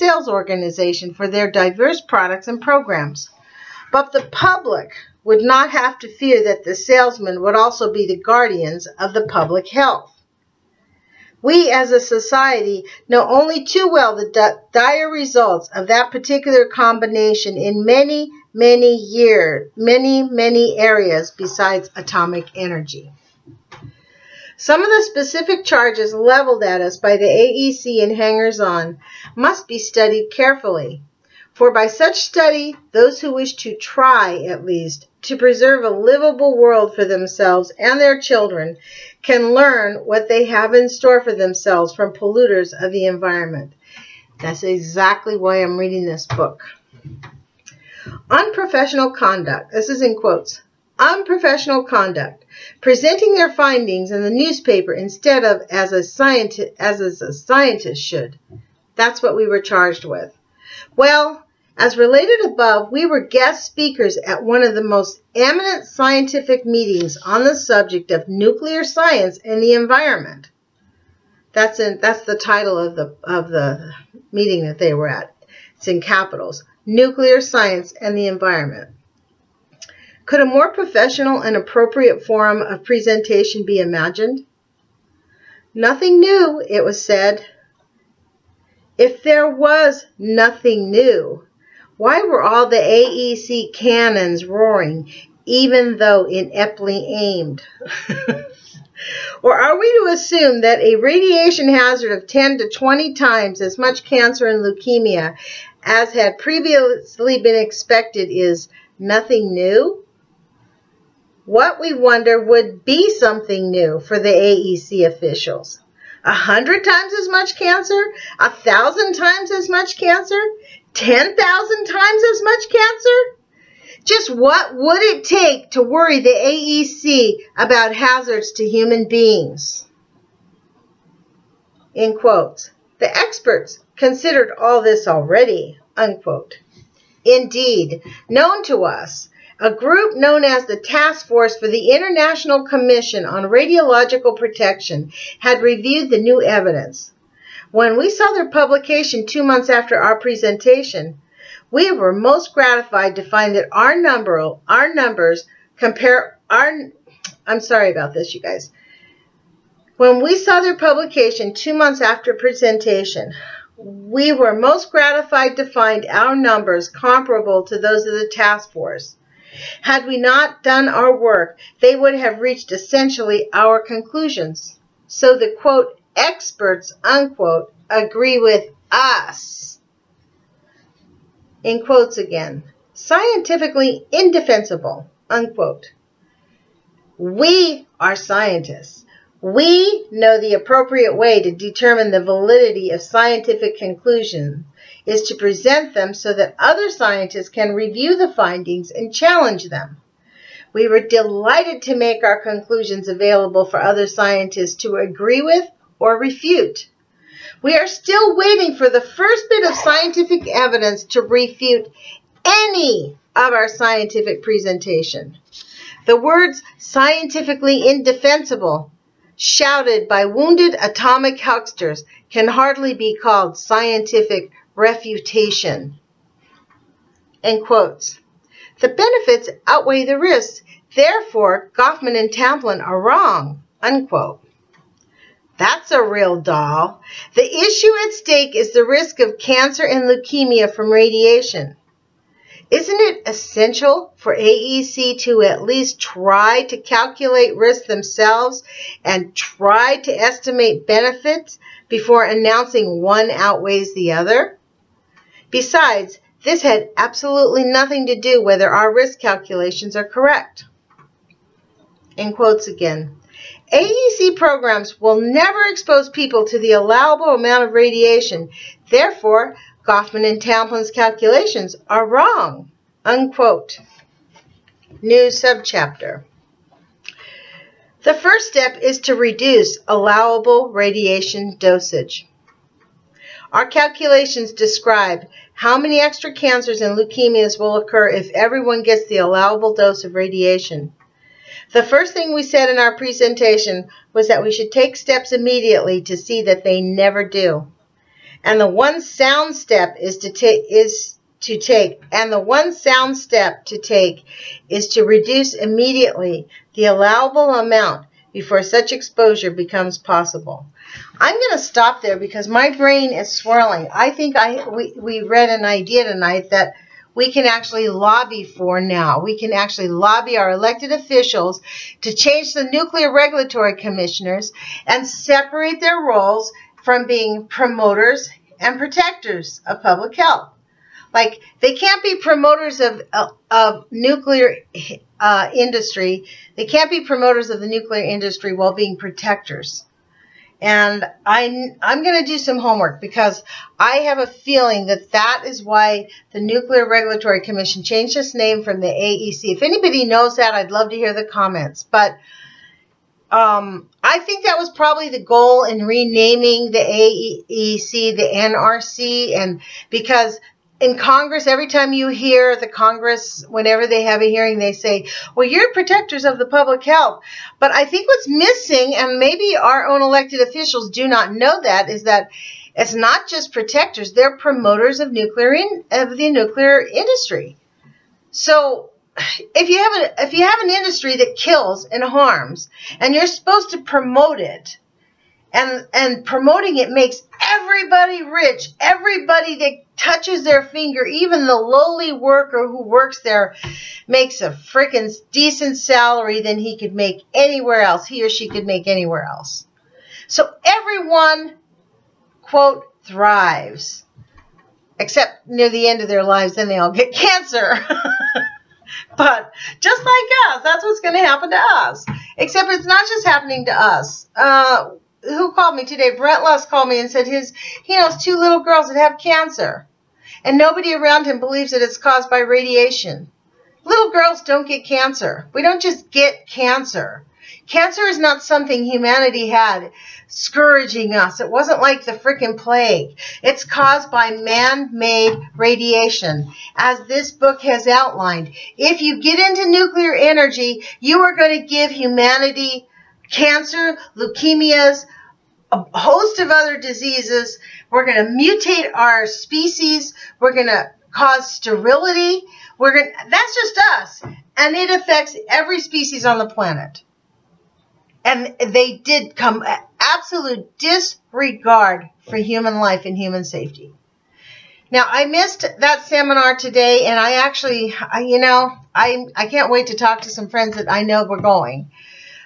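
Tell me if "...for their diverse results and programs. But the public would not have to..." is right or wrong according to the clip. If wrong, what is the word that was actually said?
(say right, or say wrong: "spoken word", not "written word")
wrong: "products", not "results".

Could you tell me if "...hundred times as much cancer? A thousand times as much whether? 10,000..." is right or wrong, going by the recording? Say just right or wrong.
wrong.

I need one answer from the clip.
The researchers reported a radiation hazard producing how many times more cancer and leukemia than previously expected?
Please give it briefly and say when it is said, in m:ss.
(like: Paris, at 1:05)
10 to 20 times, at 1:42.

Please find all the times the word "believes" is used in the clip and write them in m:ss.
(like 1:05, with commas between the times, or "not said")
7:01.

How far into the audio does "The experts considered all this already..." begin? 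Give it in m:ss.
2:12.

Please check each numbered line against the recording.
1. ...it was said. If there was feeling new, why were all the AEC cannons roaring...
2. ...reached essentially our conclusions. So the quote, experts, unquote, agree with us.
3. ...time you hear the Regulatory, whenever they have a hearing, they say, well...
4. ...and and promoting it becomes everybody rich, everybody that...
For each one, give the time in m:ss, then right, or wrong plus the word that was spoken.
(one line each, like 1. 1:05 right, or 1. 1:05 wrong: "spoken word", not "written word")
1. 1:26 wrong: "nothing", not "feeling"
2. 2:52 right
3. 6:01 wrong: "Congress", not "Regulatory"
4. 6:25 wrong: "makes", not "becomes".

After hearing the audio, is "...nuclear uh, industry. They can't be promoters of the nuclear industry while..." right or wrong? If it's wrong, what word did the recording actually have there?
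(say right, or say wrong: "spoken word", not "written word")
right.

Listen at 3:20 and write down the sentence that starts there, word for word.
We were delighted to make our conclusions available for other scientists to agree with or refute.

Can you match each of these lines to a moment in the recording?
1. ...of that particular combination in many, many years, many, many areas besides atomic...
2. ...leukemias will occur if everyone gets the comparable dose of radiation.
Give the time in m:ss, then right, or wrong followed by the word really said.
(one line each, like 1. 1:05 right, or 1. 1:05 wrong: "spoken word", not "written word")
1. 0:15 right
2. 4:46 wrong: "allowable", not "comparable".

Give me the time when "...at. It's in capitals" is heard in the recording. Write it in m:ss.
1:15.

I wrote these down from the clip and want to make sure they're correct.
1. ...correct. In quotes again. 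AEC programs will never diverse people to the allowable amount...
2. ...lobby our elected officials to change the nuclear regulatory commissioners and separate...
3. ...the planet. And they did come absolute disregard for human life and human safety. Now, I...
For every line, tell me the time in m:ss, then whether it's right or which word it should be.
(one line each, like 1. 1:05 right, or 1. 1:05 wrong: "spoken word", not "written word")
1. 4:20 wrong: "expose", not "diverse"
2. 5:19 right
3. 7:36 right.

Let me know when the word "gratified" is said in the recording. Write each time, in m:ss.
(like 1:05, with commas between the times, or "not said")
2:32, 2:44.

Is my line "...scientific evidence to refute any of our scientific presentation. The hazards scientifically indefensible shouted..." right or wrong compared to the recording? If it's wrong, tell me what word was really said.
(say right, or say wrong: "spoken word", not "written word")
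wrong: "words", not "hazards".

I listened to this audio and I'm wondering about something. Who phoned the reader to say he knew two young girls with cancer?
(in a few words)
Brett Luss.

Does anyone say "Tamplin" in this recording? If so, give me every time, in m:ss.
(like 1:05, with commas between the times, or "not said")
3:52, 4:30.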